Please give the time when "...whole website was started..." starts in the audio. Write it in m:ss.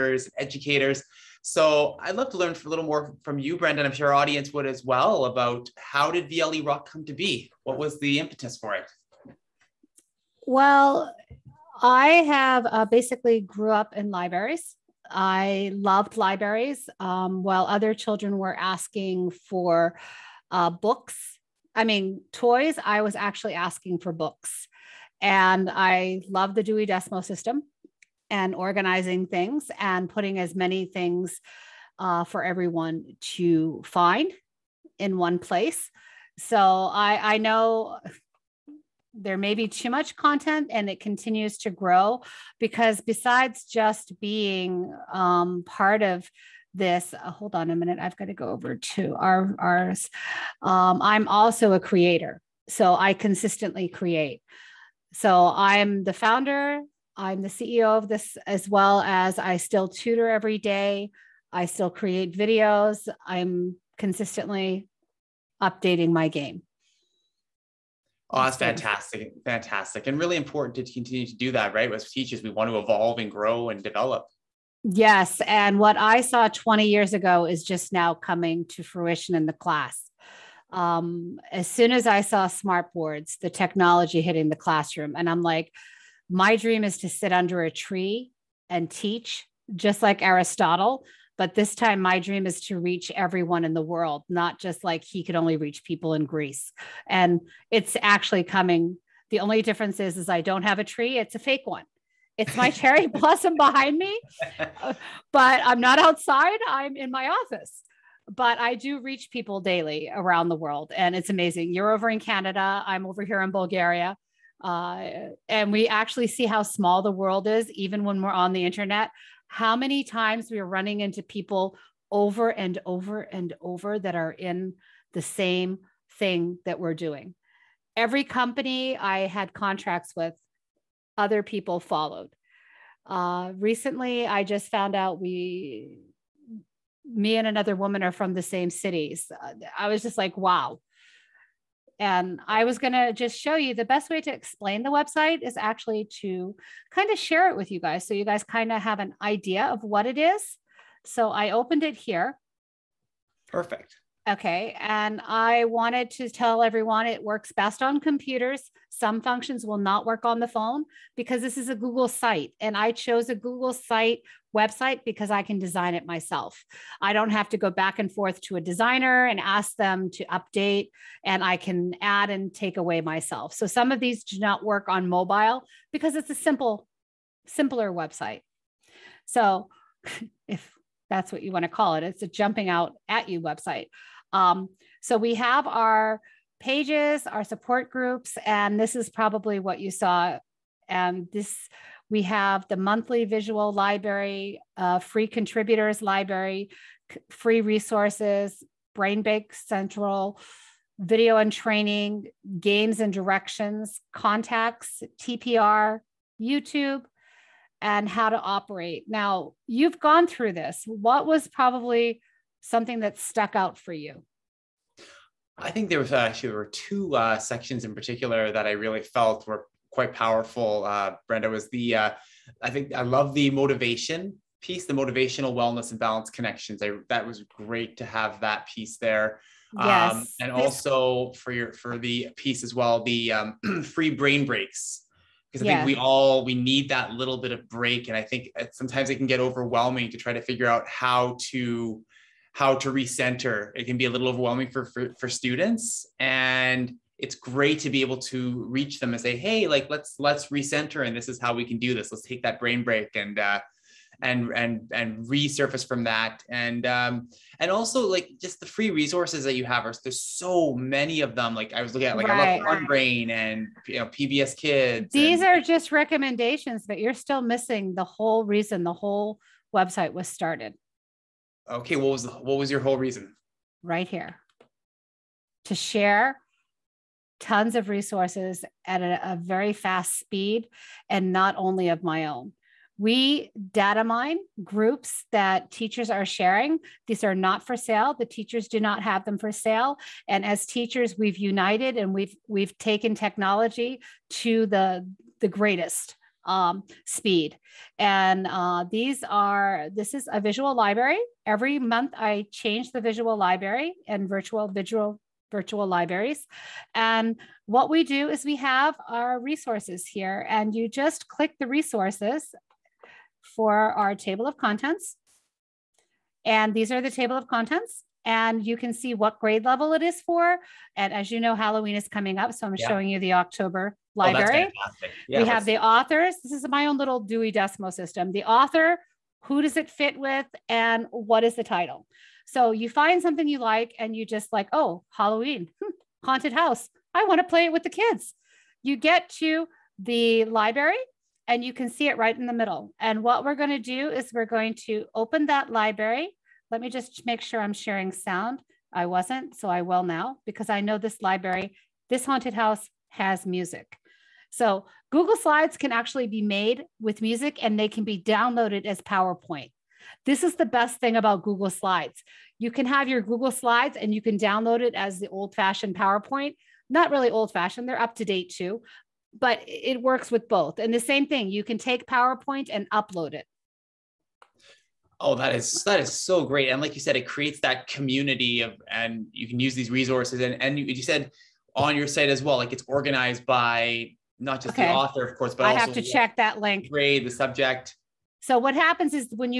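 4:28.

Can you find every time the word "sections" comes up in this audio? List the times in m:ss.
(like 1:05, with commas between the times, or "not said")
3:37.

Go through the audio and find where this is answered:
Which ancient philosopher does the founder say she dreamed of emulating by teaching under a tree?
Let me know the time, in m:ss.
1:30.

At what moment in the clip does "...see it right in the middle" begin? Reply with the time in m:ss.
5:41.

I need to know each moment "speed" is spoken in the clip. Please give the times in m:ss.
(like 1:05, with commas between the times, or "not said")
4:40, 4:57.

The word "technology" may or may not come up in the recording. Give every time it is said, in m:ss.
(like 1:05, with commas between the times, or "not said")
1:23, 4:53.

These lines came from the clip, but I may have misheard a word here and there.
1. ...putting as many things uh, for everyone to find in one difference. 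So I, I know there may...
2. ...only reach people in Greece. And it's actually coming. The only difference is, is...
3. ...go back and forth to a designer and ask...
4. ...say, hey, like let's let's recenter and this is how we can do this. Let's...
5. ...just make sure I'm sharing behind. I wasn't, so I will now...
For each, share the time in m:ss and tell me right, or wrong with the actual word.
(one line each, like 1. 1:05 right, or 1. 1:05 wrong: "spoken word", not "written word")
1. 0:30 wrong: "place", not "difference"
2. 1:35 right
3. 2:47 right
4. 4:09 right
5. 5:46 wrong: "sound", not "behind".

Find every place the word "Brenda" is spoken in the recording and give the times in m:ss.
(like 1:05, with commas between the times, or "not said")
0:03, 3:41.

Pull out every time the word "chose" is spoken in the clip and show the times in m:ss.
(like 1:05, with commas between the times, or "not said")
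2:42.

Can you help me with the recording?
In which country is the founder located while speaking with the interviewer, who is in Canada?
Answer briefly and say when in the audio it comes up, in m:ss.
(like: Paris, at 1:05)
Bulgaria, at 1:53.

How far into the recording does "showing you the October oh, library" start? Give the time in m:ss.
5:22.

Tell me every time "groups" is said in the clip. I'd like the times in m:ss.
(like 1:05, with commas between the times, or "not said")
3:07, 4:44.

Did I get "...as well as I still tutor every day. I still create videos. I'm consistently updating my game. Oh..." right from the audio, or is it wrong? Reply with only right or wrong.
right.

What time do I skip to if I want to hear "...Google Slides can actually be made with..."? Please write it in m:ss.
5:55.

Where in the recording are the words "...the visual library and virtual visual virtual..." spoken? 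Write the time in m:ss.
5:02.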